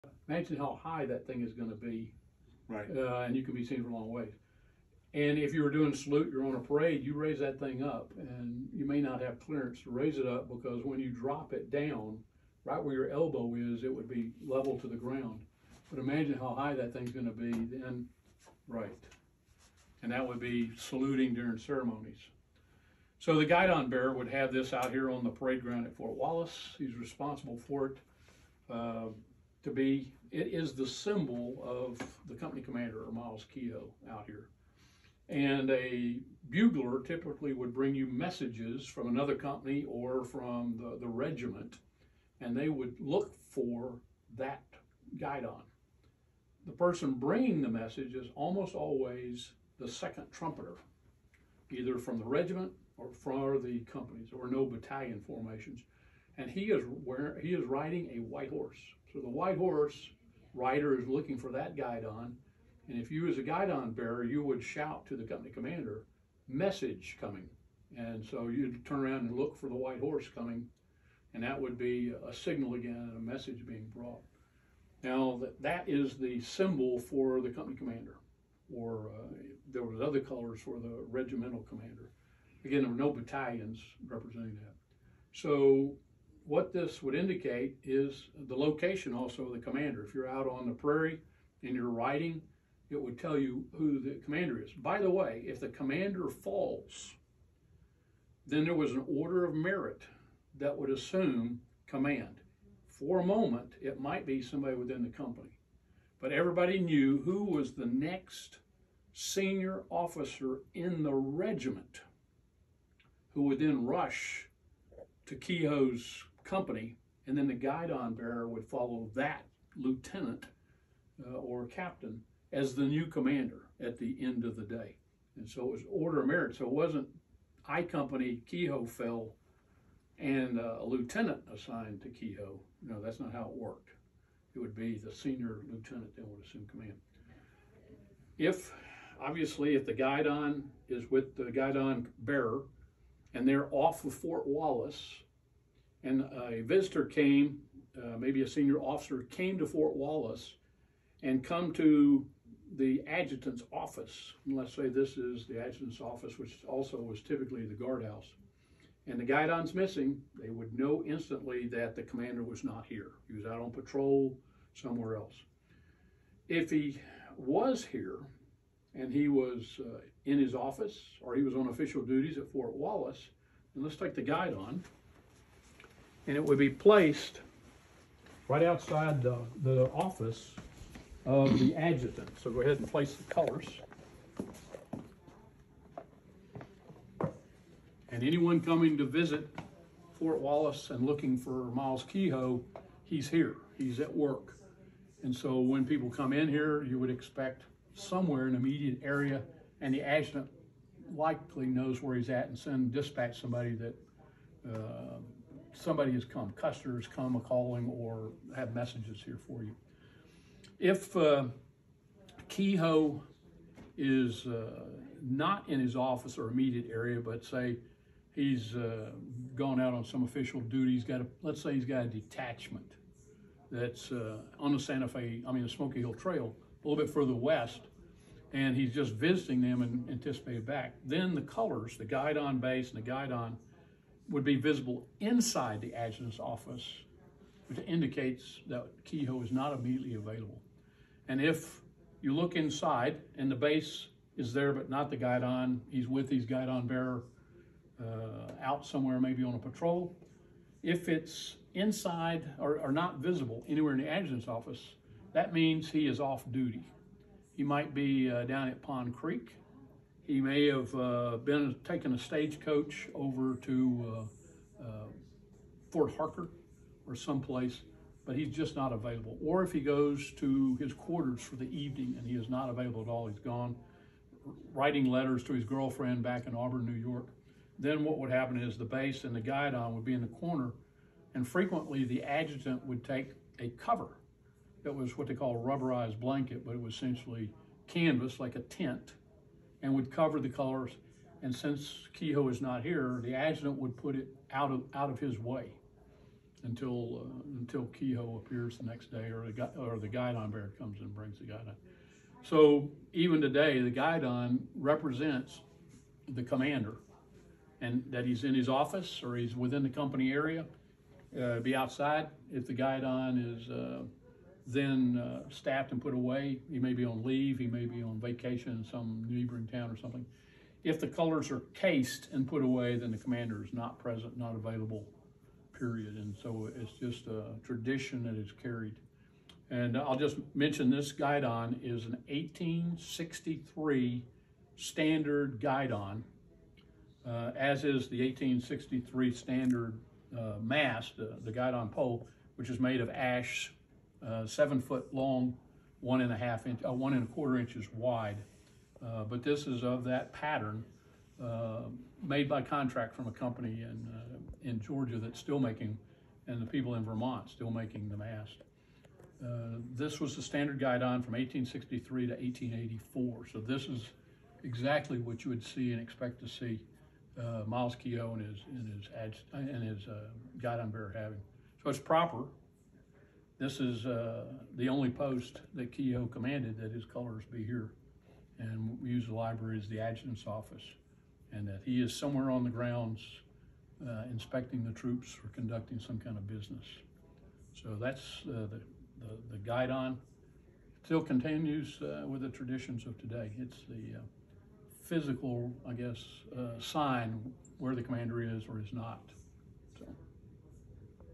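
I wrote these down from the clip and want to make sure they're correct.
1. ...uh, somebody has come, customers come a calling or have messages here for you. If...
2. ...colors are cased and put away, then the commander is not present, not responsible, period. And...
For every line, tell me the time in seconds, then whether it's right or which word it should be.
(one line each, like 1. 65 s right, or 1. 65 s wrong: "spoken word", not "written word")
1. 204 s right
2. 321 s wrong: "available", not "responsible".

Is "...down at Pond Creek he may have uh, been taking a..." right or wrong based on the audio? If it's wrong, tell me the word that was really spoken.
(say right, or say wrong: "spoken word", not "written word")
right.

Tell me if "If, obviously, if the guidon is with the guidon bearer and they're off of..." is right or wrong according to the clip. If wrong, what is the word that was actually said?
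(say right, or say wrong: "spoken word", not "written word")
right.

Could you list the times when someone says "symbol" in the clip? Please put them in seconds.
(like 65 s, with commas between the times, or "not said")
30 s, 76 s.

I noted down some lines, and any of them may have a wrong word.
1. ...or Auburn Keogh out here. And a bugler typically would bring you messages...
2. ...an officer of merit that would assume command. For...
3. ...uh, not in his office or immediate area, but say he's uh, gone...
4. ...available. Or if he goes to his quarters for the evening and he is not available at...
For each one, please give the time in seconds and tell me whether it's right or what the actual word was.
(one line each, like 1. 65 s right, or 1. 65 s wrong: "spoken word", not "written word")
1. 33 s wrong: "Myles", not "Auburn"
2. 98 s wrong: "order", not "officer"
3. 214 s right
4. 268 s right.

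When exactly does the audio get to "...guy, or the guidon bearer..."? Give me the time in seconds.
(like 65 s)
299 s.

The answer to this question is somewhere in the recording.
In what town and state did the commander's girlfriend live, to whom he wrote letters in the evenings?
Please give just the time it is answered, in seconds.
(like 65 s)
276 s.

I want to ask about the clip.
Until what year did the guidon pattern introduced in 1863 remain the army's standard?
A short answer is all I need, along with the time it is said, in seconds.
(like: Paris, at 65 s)
1884, at 362 s.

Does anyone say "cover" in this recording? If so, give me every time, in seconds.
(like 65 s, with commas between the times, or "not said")
283 s, 290 s.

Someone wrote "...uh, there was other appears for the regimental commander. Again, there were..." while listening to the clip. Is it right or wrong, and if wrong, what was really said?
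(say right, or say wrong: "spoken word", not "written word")
wrong: "colors", not "appears".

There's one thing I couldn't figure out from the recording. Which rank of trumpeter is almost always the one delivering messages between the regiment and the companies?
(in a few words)
Second trumpeter.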